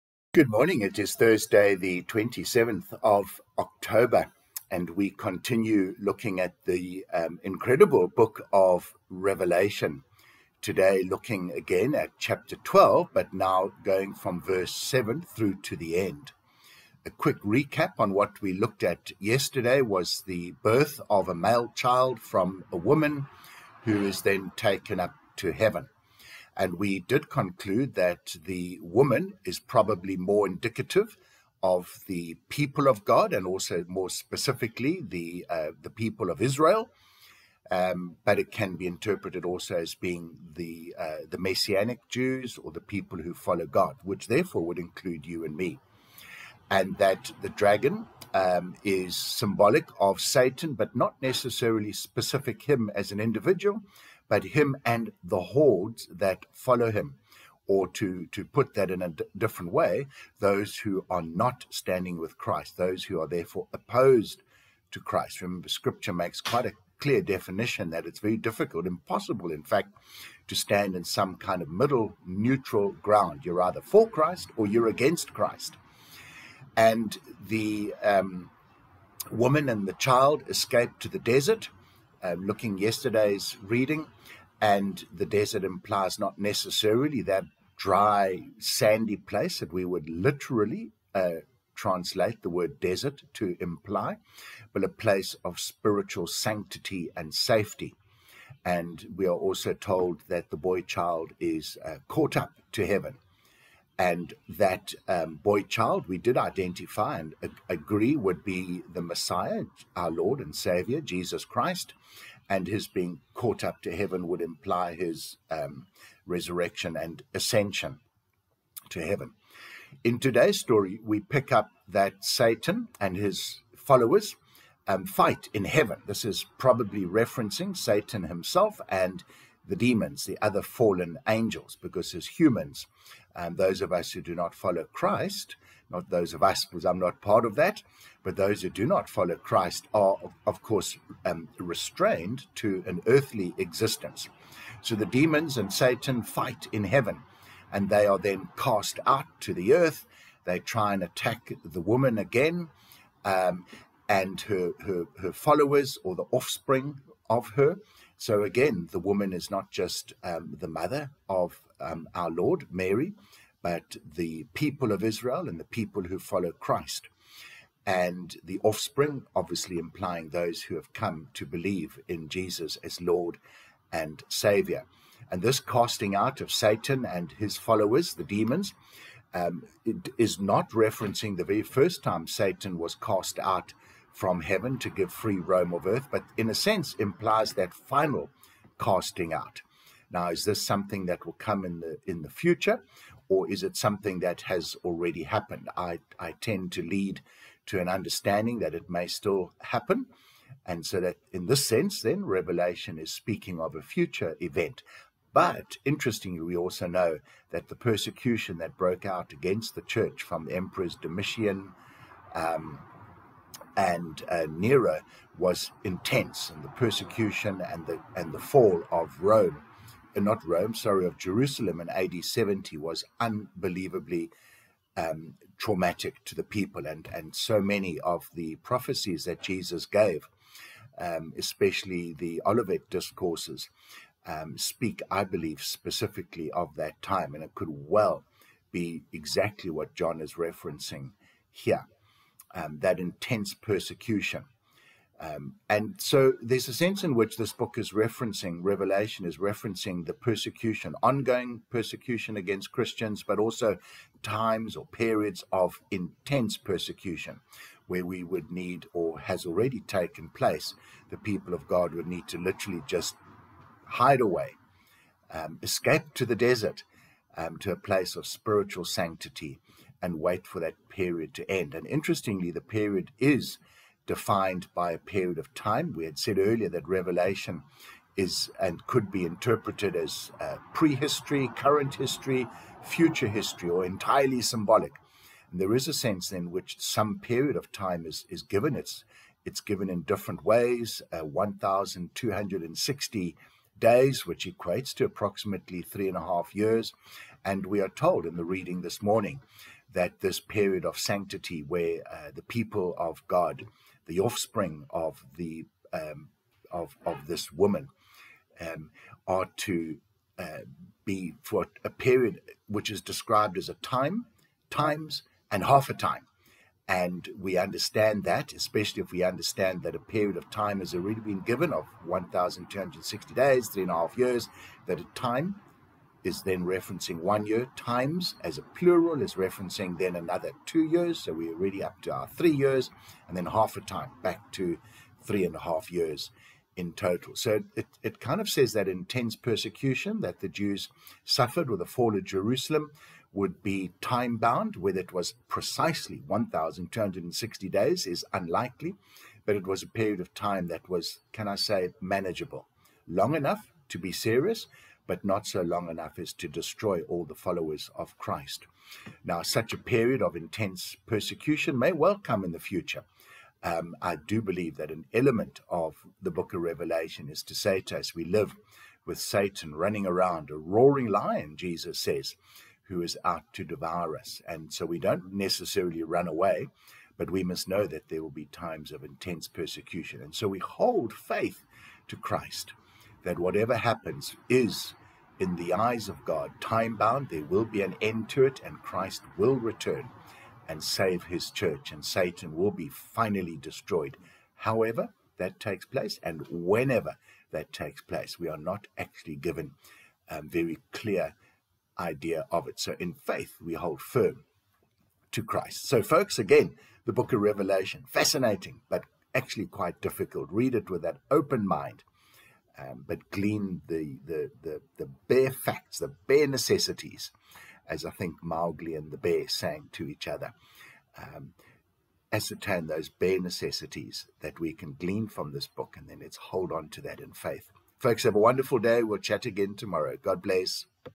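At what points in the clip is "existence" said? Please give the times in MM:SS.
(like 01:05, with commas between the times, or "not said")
02:23.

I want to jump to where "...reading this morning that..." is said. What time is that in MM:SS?
04:58.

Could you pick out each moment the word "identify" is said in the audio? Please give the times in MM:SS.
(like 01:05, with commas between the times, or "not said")
01:46.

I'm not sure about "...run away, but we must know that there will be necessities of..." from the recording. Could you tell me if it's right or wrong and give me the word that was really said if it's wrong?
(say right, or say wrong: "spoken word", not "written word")
wrong: "times", not "necessities".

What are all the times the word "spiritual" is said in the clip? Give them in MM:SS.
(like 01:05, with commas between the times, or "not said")
01:35, 04:28.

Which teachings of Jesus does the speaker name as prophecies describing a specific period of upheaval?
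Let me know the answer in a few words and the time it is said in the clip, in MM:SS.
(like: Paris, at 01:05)
Olivet discourses, at 03:52.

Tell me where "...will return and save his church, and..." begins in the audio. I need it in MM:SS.
06:29.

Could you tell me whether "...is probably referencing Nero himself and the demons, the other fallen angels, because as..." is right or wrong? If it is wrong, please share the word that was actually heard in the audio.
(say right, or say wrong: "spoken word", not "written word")
wrong: "Satan", not "Nero".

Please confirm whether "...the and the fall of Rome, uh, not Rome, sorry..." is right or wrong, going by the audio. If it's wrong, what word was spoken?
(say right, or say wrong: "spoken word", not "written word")
right.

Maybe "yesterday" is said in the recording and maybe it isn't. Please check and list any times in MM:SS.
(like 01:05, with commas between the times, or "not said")
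00:19, 01:22.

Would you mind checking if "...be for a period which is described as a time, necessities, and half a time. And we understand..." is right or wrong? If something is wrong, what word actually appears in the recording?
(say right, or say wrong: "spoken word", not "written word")
wrong: "times", not "necessities".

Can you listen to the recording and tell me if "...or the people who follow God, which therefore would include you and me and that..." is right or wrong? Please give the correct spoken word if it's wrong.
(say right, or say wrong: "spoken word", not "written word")
right.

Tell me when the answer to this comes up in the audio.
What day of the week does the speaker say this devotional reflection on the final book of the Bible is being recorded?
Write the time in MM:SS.
00:01.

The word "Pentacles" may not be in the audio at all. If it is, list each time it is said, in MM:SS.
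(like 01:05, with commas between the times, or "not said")
not said.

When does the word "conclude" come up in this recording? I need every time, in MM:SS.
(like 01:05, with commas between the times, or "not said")
00:27.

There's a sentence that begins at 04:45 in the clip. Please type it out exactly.
And there is a sense in which some period of time is, is given.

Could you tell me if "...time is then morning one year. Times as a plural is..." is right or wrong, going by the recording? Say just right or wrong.
wrong.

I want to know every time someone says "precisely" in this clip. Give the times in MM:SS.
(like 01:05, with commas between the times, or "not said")
05:45.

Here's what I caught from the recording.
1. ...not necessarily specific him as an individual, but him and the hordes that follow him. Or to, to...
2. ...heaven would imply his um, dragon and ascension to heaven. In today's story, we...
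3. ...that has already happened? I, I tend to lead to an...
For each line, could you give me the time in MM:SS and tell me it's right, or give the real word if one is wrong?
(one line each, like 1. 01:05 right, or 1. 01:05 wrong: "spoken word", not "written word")
1. 00:50 right
2. 01:53 wrong: "resurrection", not "dragon"
3. 03:14 right.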